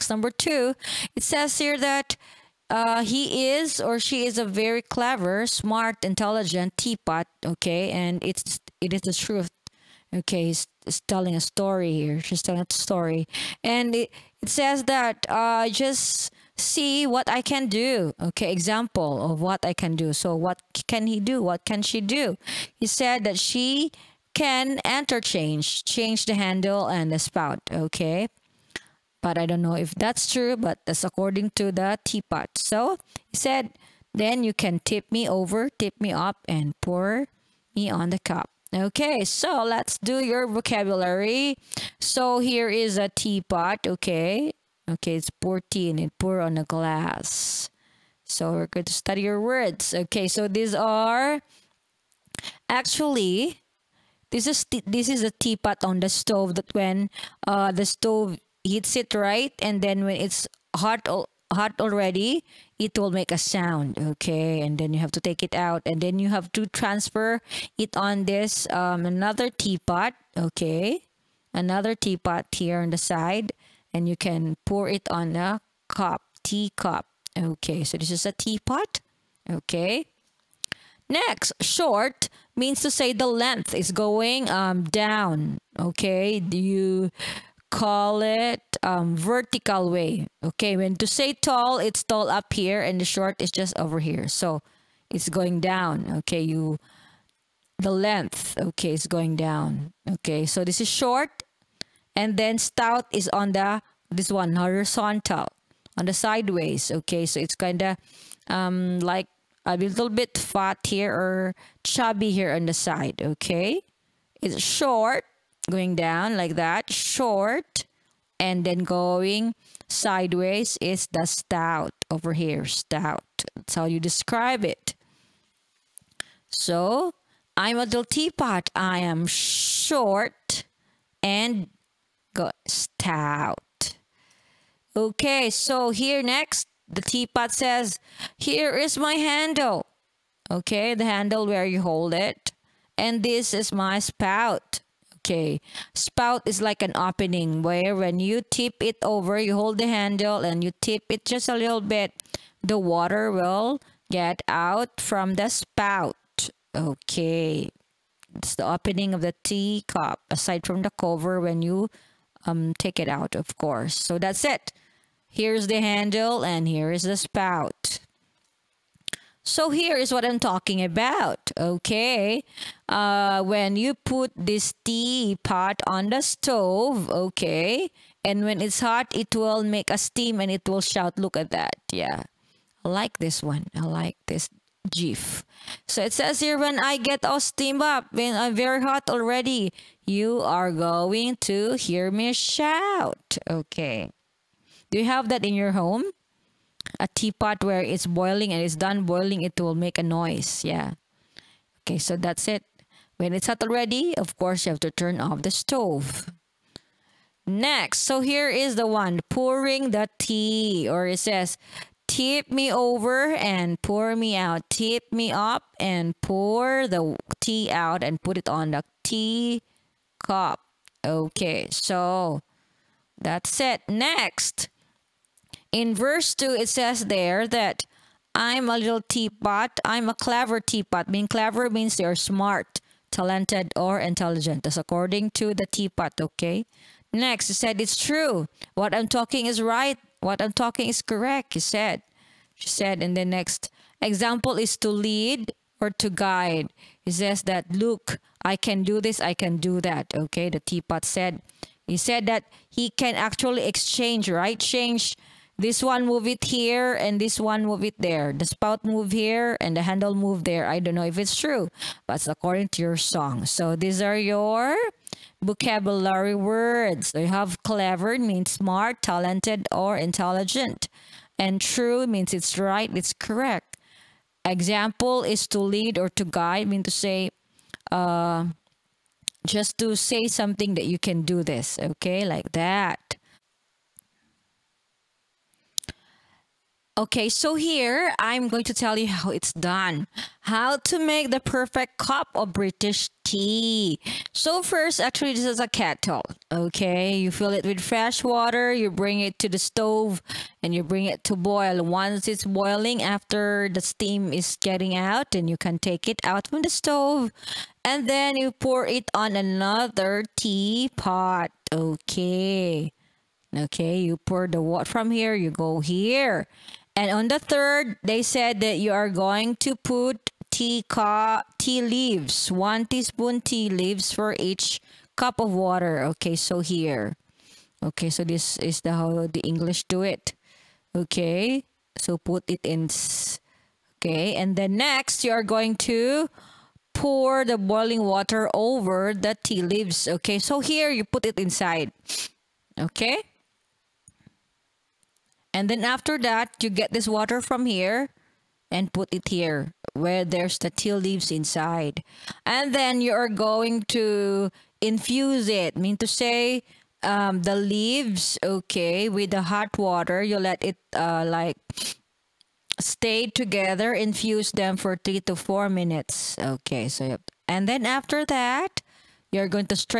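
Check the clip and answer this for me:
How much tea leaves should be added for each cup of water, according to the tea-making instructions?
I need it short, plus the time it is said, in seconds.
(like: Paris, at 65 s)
1 teaspoon, at 322 s.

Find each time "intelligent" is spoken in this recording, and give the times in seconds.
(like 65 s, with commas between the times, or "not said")
6 s, 233 s, 269 s.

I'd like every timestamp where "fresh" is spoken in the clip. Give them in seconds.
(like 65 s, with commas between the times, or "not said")
297 s.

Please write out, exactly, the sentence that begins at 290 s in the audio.
How to make the perfect cup of British tea.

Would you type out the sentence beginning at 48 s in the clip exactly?
So we're going to study your words.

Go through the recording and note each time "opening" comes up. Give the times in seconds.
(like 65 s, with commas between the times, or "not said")
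146 s, 158 s.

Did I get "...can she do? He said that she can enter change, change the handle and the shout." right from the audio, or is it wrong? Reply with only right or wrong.
wrong.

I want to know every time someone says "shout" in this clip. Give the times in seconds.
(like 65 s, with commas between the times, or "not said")
180 s, 192 s.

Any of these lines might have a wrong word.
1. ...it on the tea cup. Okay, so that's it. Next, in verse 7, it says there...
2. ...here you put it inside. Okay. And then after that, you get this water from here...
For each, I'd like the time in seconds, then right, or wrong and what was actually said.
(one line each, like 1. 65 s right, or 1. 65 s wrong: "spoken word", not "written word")
1. 218 s wrong: "2", not "7"
2. 340 s right.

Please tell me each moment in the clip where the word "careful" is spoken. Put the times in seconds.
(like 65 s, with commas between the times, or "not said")
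not said.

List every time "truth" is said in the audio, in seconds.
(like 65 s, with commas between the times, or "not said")
9 s.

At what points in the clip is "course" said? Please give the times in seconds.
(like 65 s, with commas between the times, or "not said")
163 s, 204 s.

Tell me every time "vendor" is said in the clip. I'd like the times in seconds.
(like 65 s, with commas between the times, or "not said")
not said.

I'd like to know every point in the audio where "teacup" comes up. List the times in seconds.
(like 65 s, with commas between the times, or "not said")
76 s, 159 s.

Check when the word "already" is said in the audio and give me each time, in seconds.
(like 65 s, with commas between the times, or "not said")
61 s, 189 s, 203 s.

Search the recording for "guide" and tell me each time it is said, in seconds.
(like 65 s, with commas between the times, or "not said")
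246 s, 276 s.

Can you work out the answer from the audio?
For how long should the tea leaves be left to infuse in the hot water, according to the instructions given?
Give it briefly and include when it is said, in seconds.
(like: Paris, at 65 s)
3 to 4 minutes, at 365 s.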